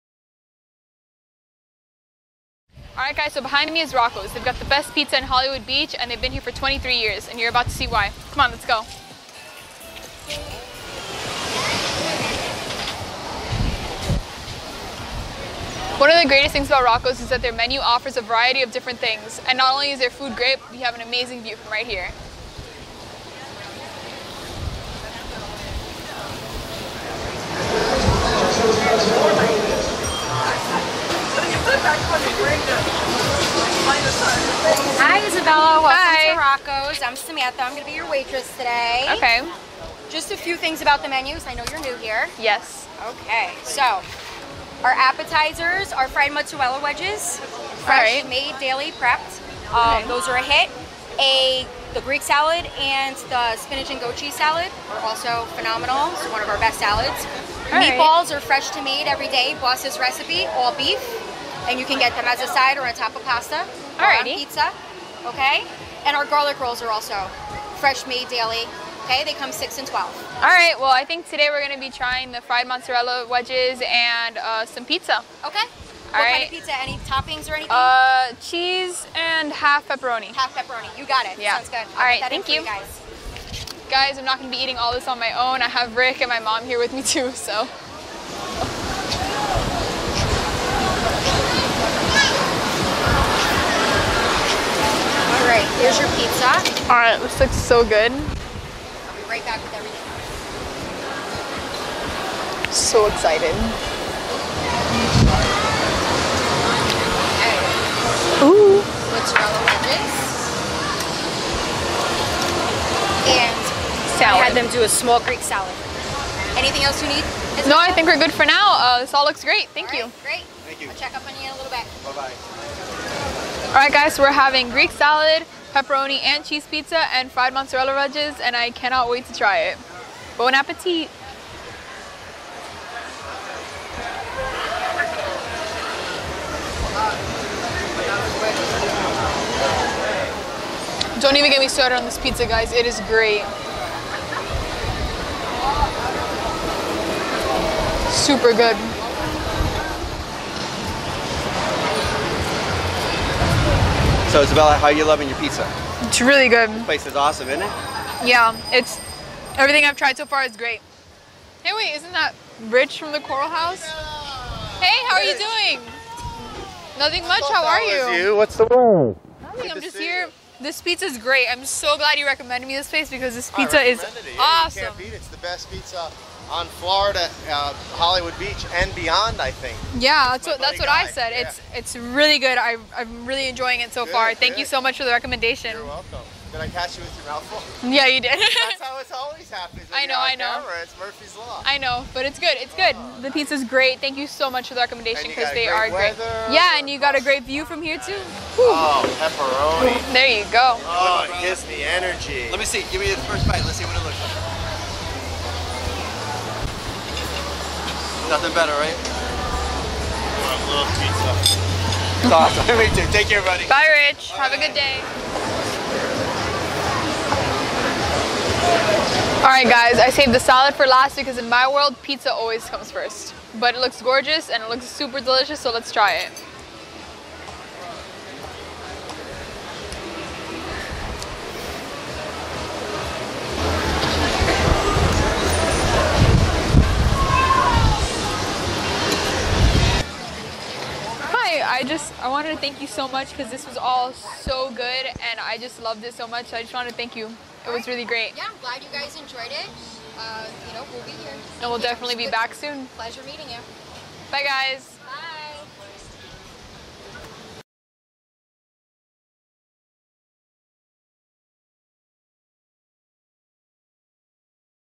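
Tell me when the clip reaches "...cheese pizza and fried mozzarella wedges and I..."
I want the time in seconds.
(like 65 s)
126 s.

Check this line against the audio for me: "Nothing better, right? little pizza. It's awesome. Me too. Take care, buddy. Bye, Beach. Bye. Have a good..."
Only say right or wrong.
wrong.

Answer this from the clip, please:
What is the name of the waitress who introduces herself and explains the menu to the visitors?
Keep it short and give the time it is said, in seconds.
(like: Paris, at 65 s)
Samantha, at 37 s.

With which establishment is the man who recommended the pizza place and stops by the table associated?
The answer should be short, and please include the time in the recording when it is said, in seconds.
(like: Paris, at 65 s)
the Coral House, at 163 s.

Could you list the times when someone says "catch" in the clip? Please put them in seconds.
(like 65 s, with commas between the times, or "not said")
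186 s.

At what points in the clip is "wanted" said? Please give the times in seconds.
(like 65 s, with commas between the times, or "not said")
242 s, 246 s.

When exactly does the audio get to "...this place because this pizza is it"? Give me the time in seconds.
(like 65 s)
172 s.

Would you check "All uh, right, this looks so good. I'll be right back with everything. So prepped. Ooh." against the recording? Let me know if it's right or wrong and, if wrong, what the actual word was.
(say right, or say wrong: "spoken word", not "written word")
wrong: "excited", not "prepped".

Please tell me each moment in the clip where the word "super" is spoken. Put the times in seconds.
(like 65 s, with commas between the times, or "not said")
148 s, 224 s.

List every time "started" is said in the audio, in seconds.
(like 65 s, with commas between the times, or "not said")
141 s.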